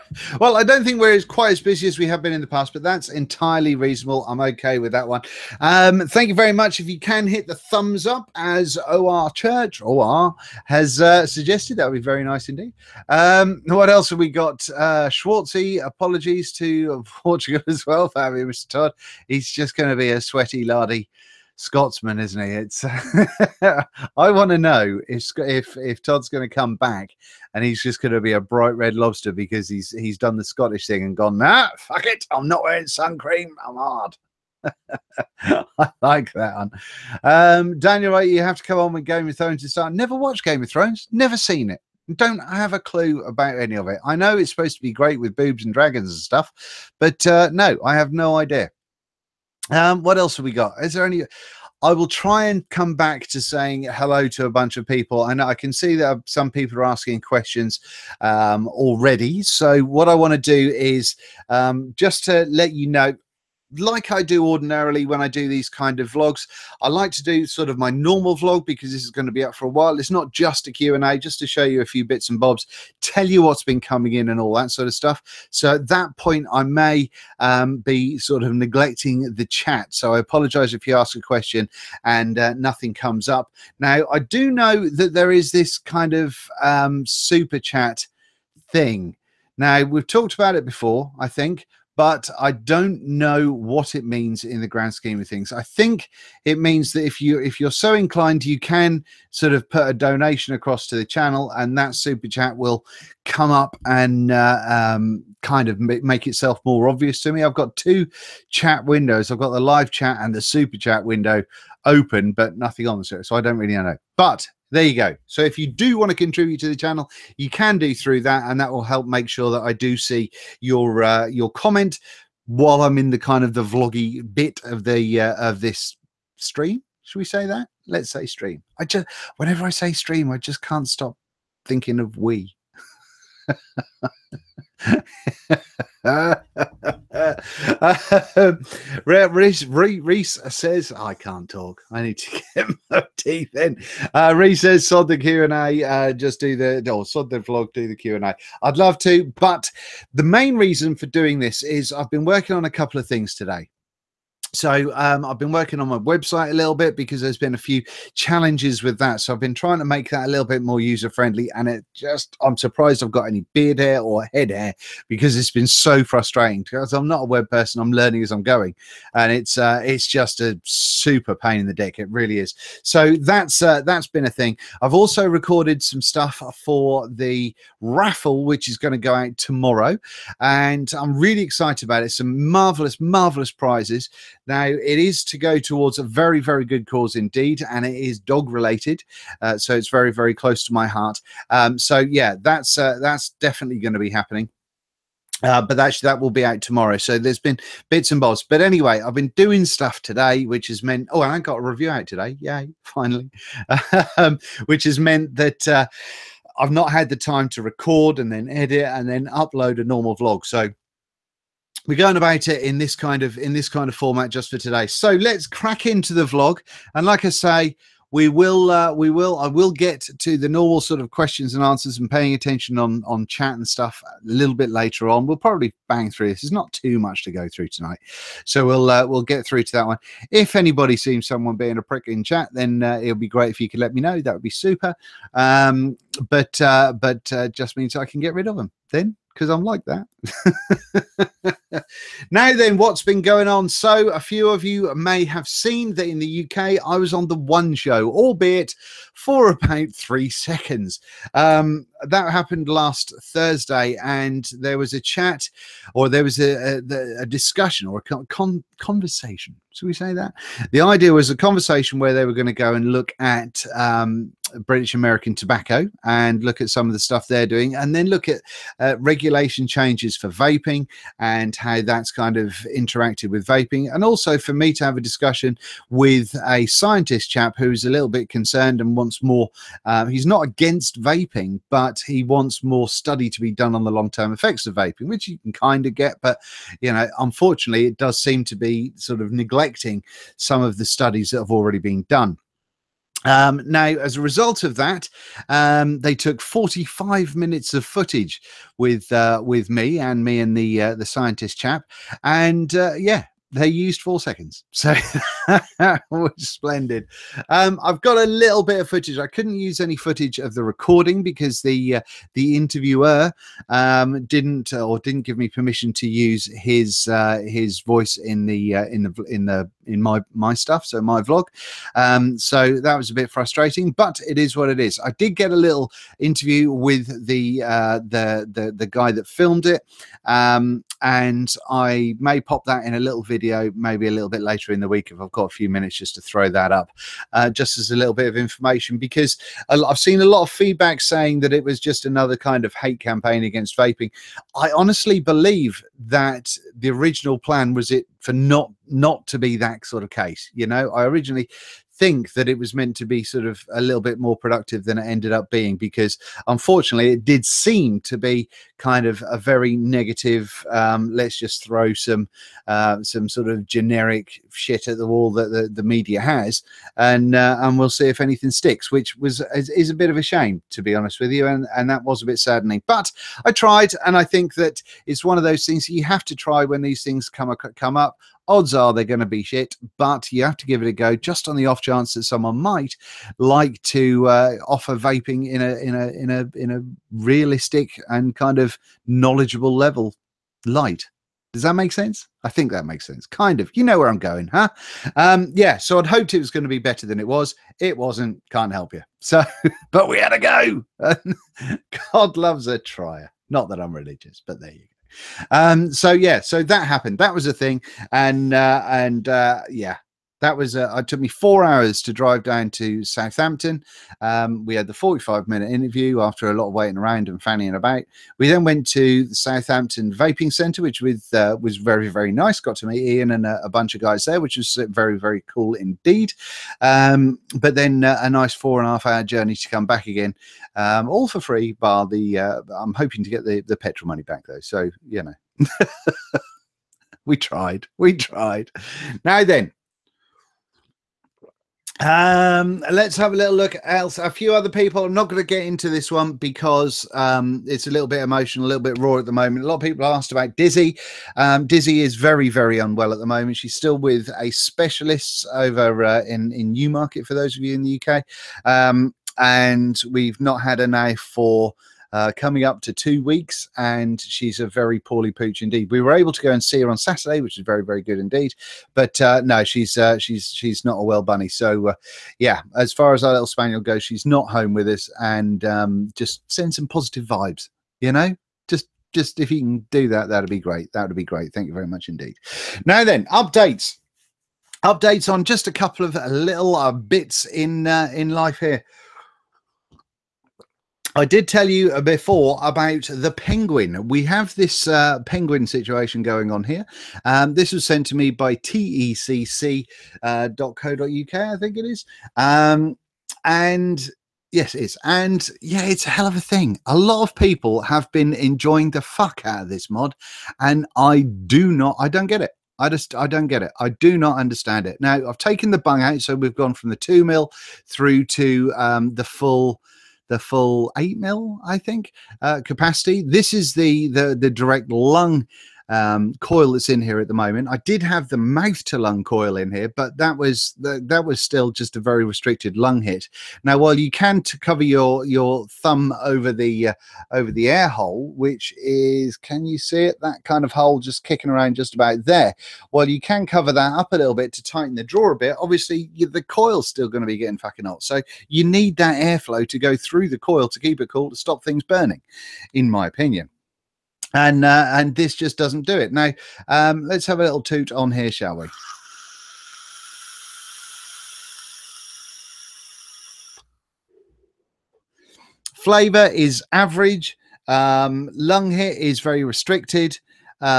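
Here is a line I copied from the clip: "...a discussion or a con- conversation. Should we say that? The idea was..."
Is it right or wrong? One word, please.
right.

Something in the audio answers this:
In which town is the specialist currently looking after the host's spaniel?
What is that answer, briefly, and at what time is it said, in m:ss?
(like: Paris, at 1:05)
Newmarket, at 7:36.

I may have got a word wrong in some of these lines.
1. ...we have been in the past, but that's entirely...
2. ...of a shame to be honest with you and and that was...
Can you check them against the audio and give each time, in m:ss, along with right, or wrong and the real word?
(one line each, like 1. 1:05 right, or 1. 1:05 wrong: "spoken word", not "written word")
1. 0:01 right
2. 6:10 right.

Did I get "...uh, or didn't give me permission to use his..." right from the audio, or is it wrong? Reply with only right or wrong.
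right.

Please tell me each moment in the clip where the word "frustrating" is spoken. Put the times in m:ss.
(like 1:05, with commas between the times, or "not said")
2:46, 5:23.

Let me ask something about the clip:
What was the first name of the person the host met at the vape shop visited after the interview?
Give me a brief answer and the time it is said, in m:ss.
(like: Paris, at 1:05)
Ian, at 7:03.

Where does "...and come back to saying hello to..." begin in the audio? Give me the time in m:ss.
0:52.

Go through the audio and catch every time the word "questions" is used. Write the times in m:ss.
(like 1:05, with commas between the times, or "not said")
0:57, 1:21, 3:41.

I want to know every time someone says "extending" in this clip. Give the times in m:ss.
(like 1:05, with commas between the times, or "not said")
not said.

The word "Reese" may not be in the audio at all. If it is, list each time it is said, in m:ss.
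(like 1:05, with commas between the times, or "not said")
2:19, 2:24.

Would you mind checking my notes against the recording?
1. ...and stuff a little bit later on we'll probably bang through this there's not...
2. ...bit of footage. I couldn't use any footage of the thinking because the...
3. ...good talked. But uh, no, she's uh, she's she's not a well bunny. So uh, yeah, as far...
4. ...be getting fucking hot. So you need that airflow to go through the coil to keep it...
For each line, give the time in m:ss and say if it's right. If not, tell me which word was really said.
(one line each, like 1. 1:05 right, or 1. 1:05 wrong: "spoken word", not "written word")
1. 3:43 right
2. 5:08 wrong: "recording", not "thinking"
3. 7:48 wrong: "indeed", not "talked"
4. 9:07 right.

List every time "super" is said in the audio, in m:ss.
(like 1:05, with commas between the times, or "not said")
1:27, 1:41, 1:50, 2:50, 3:54.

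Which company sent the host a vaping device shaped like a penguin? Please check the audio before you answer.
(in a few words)
tecc.co.uk.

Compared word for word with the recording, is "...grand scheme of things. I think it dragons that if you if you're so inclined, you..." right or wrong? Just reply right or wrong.
wrong.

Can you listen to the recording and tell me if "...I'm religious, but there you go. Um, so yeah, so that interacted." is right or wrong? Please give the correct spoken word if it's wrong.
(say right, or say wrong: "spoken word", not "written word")
wrong: "happened", not "interacted".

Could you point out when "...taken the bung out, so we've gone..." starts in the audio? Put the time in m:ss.
8:35.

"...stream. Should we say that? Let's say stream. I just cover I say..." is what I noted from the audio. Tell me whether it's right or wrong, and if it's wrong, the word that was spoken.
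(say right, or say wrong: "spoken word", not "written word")
wrong: "whenever", not "cover".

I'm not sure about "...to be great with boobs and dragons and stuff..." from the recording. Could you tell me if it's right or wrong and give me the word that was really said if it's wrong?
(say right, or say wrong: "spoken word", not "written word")
right.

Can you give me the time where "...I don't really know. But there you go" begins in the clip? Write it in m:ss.
1:53.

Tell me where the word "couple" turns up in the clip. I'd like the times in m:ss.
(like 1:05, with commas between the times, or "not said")
2:32, 8:05.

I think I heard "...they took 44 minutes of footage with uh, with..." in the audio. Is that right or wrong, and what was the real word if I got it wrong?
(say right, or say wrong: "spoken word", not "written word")
wrong: "45", not "44".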